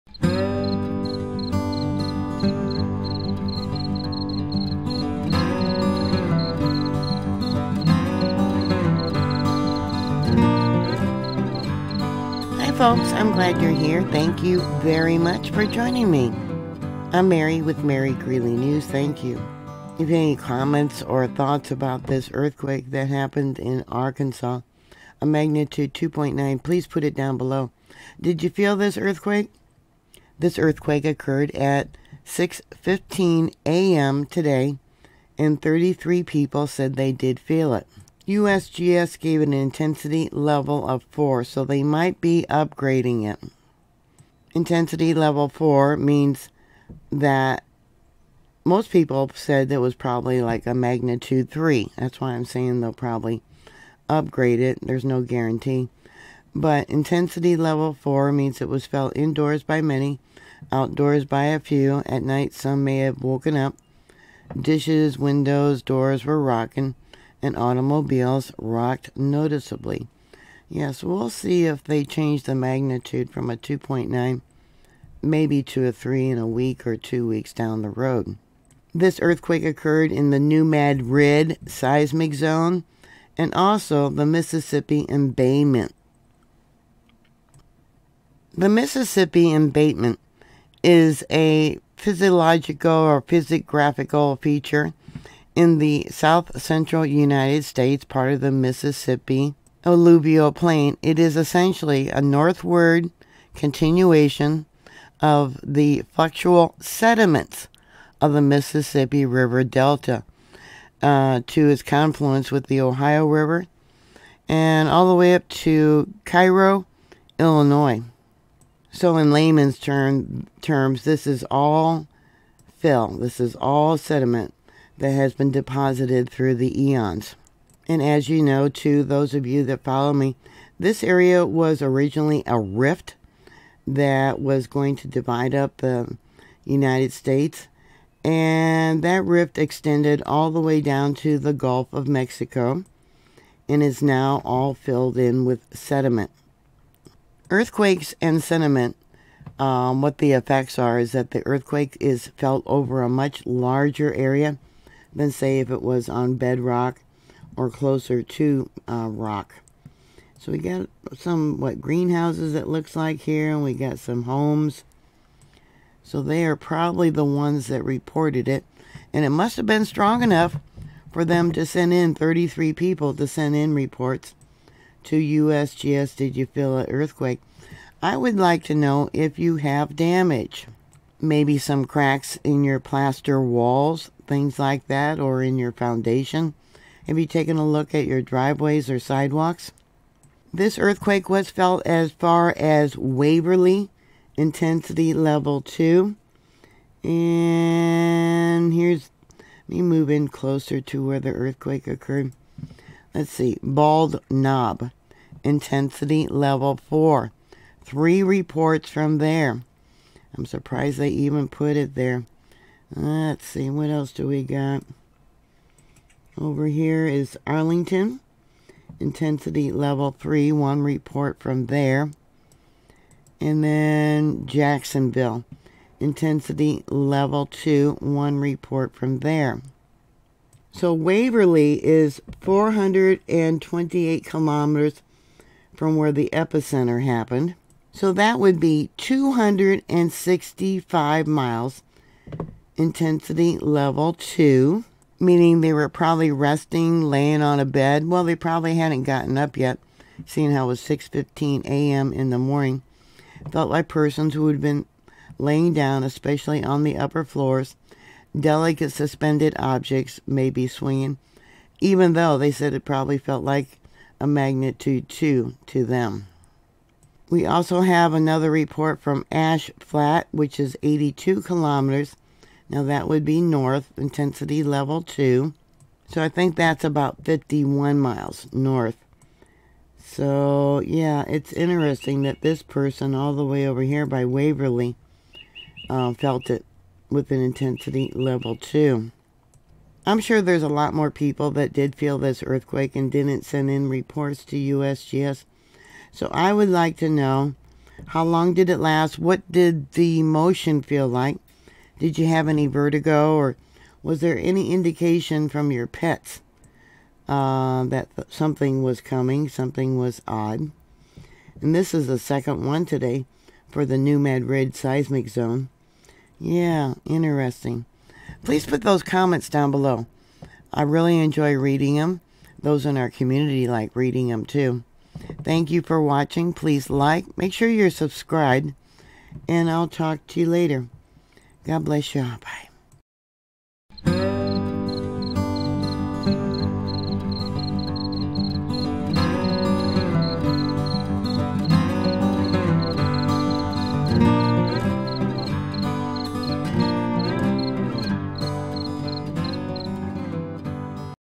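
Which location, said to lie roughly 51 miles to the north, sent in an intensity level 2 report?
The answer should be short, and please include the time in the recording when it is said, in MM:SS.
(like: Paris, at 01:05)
Ash Flat, at 04:29.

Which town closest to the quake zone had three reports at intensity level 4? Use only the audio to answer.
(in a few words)
Bald Knob.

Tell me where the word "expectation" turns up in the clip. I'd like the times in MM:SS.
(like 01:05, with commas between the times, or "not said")
not said.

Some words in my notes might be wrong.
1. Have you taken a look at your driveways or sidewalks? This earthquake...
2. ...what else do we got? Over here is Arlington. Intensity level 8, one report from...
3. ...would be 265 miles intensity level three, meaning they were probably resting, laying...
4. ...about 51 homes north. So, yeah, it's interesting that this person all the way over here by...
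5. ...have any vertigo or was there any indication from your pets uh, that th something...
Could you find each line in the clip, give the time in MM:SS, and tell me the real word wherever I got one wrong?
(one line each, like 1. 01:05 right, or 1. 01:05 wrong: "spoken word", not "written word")
1. 03:07 right
2. 03:33 wrong: "3", not "8"
3. 03:58 wrong: "two", not "three"
4. 04:36 wrong: "miles", not "homes"
5. 05:02 right.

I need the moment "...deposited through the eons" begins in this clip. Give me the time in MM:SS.
02:05.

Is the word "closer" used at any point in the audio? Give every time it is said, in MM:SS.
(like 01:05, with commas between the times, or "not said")
02:37, 03:20.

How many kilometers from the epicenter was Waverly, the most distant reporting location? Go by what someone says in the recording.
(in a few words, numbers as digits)
428 kilometers.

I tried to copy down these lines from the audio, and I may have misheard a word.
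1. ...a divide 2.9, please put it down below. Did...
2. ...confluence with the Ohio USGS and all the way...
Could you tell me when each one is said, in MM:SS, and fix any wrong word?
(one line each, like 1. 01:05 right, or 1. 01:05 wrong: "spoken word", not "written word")
1. 00:25 wrong: "magnitude", not "divide"
2. 01:51 wrong: "River", not "USGS".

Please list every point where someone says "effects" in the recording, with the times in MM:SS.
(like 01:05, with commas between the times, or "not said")
02:30.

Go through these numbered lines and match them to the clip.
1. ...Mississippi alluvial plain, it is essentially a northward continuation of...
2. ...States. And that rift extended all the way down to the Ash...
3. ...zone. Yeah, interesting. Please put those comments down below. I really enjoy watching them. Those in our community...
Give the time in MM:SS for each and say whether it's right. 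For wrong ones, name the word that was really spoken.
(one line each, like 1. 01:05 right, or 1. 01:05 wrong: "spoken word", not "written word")
1. 01:38 right
2. 02:17 wrong: "Gulf", not "Ash"
3. 05:15 wrong: "reading", not "watching".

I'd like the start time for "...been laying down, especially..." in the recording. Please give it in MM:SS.
04:14.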